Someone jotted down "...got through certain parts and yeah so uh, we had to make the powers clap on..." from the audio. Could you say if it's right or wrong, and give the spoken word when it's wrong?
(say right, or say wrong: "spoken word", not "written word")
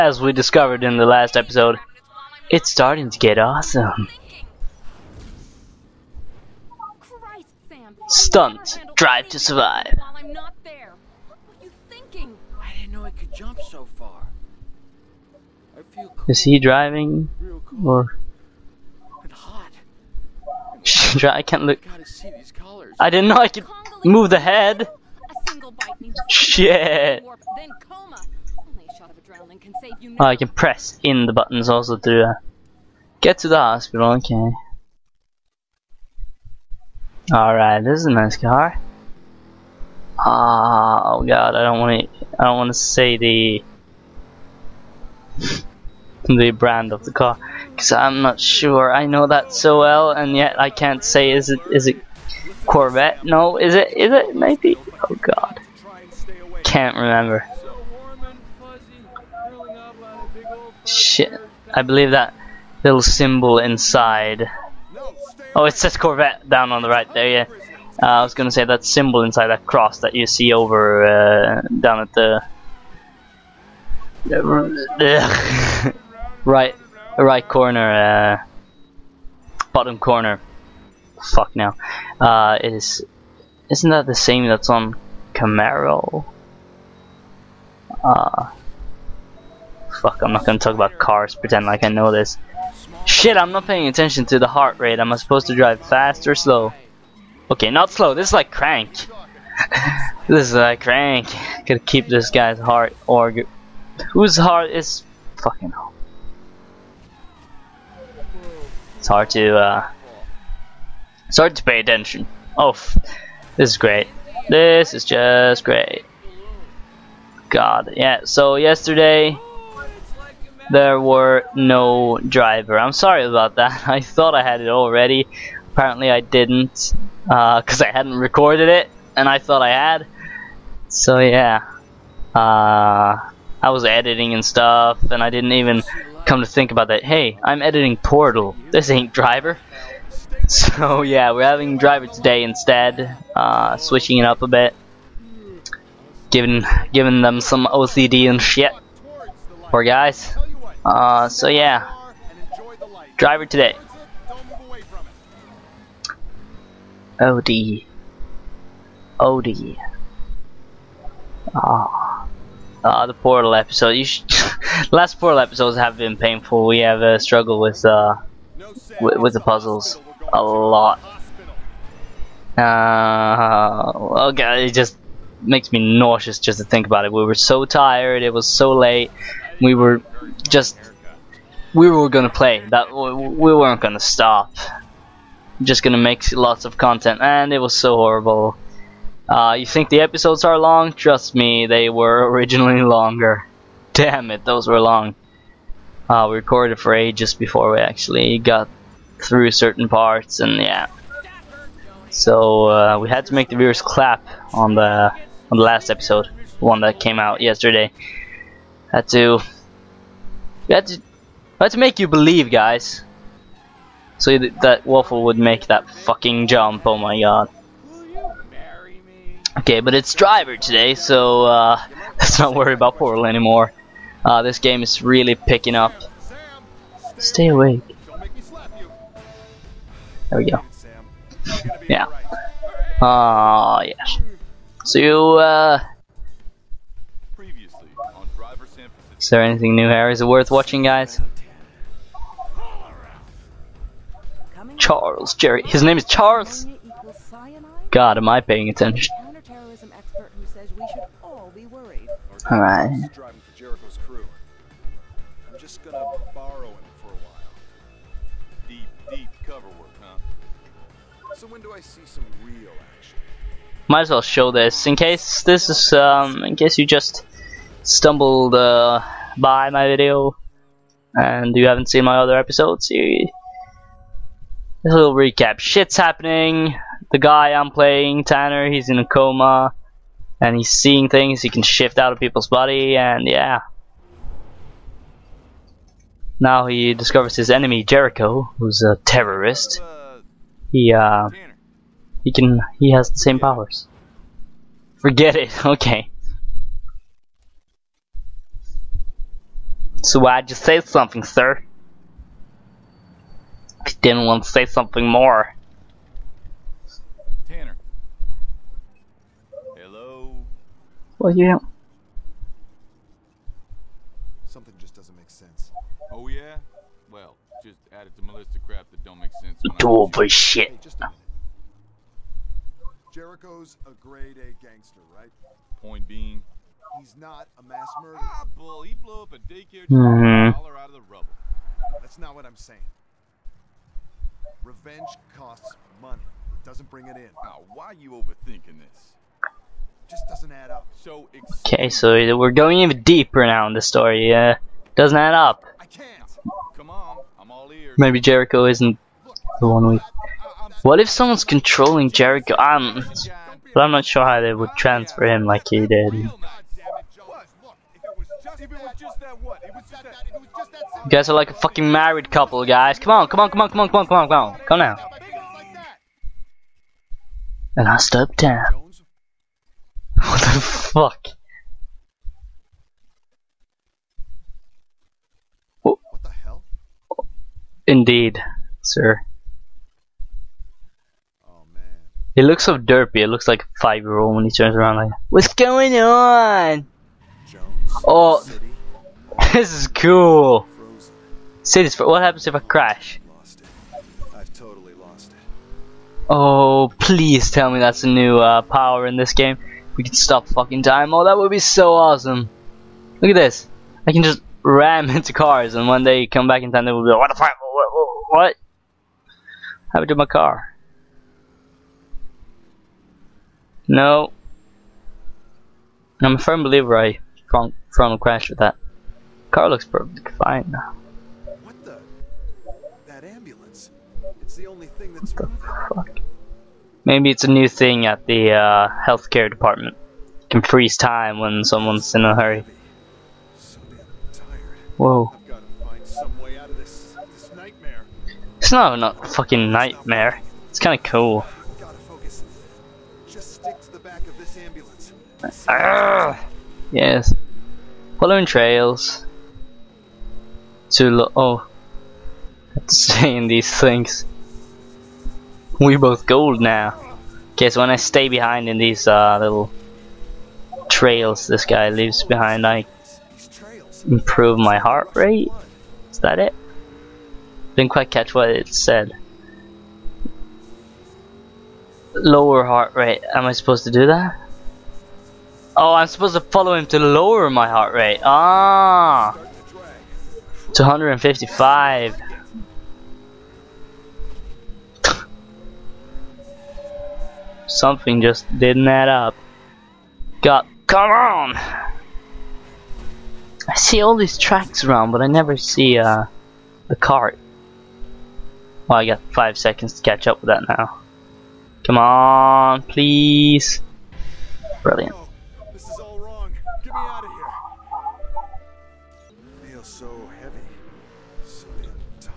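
wrong: "viewers", not "powers".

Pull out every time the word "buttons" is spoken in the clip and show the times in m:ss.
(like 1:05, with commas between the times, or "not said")
0:31.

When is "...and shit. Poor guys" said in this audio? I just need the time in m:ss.
2:28.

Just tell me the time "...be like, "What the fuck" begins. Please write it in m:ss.
6:47.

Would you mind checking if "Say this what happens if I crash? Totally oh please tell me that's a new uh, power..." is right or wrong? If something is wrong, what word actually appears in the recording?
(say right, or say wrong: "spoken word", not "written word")
right.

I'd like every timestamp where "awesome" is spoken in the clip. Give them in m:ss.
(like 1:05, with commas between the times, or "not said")
0:03, 6:41.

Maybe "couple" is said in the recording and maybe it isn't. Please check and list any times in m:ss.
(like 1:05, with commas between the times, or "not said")
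6:02.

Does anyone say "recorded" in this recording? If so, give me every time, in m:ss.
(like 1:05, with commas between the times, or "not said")
2:08, 3:16.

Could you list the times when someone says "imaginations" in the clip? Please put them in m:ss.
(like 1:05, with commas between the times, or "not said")
not said.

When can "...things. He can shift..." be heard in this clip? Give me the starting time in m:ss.
4:41.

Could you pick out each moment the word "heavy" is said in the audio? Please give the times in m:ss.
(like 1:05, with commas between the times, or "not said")
8:30.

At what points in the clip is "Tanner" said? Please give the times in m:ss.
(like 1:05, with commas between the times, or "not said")
4:38, 5:07.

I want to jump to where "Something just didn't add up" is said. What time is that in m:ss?
8:07.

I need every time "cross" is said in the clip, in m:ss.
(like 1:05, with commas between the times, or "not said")
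1:09.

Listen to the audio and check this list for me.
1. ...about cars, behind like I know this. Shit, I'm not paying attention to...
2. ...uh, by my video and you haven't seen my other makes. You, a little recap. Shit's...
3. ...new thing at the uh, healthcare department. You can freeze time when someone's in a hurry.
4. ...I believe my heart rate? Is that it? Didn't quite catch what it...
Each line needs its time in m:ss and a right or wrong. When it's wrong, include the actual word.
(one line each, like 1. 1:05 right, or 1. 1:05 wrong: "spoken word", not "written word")
1. 1:30 wrong: "pretend", not "behind"
2. 4:28 wrong: "episodes", not "makes"
3. 7:07 right
4. 7:42 wrong: "improve", not "believe".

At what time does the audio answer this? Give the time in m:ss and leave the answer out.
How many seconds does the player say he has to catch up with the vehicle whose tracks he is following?
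8:19.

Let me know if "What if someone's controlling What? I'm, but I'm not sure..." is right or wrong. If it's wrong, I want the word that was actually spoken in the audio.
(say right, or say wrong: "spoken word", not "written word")
wrong: "Jericho", not "What".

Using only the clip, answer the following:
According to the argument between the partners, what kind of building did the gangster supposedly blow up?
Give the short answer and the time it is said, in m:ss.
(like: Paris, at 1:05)
a daycare, at 5:28.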